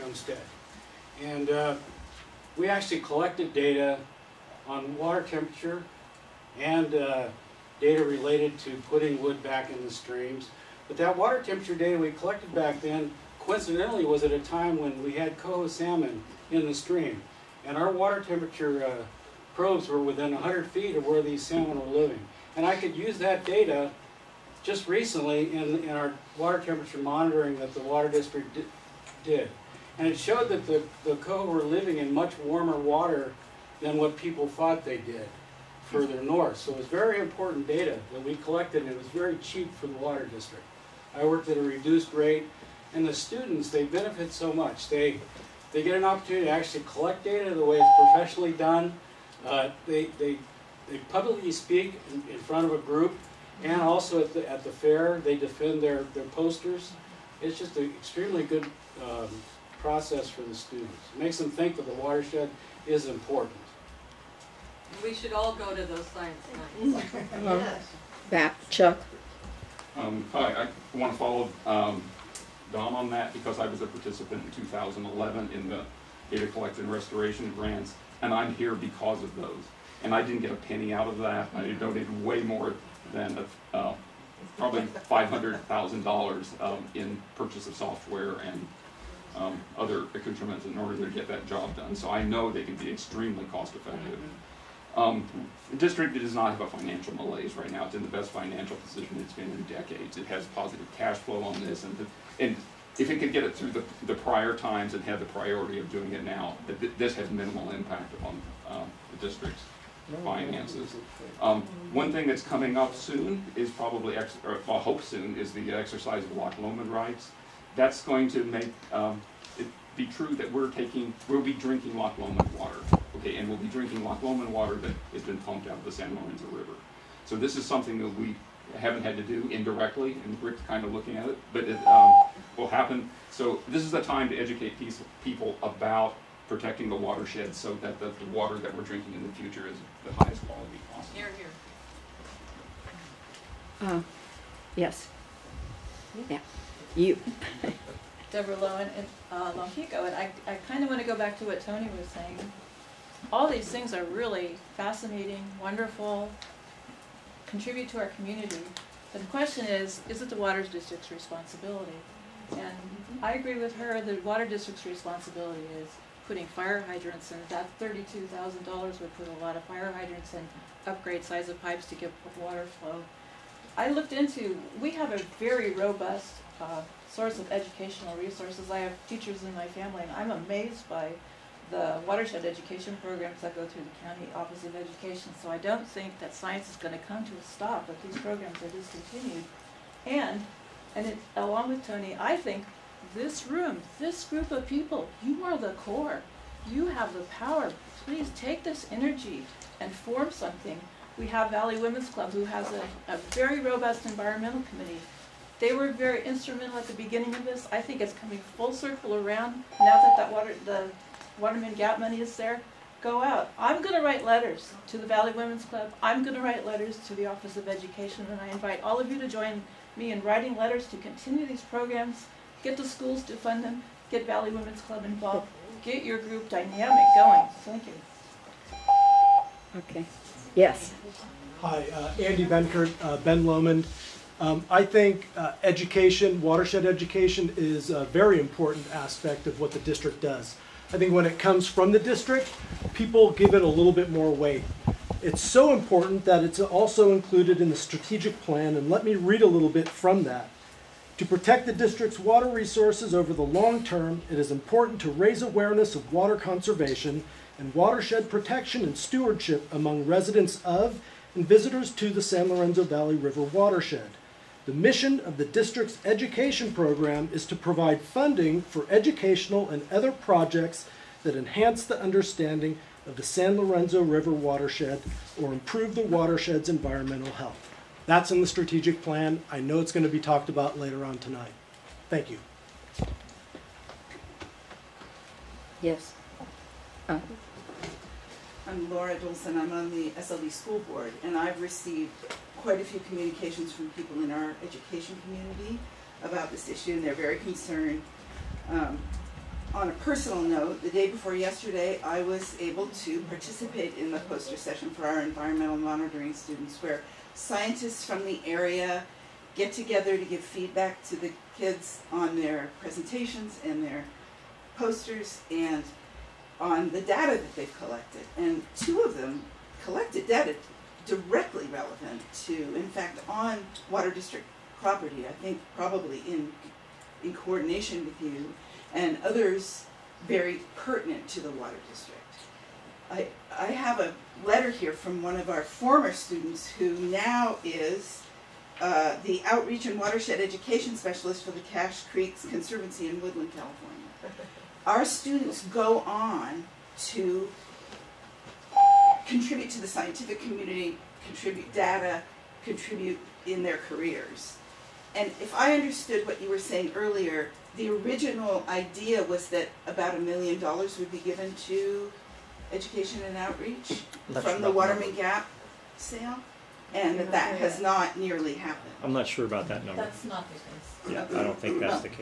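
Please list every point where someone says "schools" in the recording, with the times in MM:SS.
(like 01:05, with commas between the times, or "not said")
03:42, 04:50.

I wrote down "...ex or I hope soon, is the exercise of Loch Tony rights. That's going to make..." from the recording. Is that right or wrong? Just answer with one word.
wrong.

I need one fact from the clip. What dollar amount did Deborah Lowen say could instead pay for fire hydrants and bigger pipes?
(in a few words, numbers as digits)
$32,000.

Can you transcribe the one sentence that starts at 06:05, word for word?
Gap sale, and that that has not nearly happened.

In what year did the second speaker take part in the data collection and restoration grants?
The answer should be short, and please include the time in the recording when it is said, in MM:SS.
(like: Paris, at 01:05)
2011, at 01:14.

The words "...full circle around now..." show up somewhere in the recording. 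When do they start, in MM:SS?
03:28.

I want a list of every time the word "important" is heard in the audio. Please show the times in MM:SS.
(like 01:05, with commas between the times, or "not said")
00:37, 01:03, 03:58, 04:05, 04:14.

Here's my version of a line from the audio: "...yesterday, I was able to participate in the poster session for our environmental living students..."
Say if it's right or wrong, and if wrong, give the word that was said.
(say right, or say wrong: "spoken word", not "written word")
wrong: "monitoring", not "living".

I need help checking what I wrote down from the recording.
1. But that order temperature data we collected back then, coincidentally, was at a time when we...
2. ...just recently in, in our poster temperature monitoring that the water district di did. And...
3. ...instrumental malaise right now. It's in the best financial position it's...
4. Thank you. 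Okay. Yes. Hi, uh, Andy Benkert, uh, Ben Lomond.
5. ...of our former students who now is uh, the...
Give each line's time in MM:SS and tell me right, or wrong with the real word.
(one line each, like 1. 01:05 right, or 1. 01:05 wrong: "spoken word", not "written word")
1. 00:10 wrong: "water", not "order"
2. 00:24 wrong: "water", not "poster"
3. 01:36 wrong: "financial", not "instrumental"
4. 03:47 right
5. 05:35 right.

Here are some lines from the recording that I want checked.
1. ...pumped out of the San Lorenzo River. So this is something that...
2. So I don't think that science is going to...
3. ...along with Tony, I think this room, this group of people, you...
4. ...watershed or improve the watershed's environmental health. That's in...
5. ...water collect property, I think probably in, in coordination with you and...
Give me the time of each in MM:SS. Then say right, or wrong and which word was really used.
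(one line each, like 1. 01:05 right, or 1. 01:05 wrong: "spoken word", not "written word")
1. 02:05 right
2. 03:05 right
3. 03:11 right
4. 04:34 right
5. 05:23 wrong: "district", not "collect".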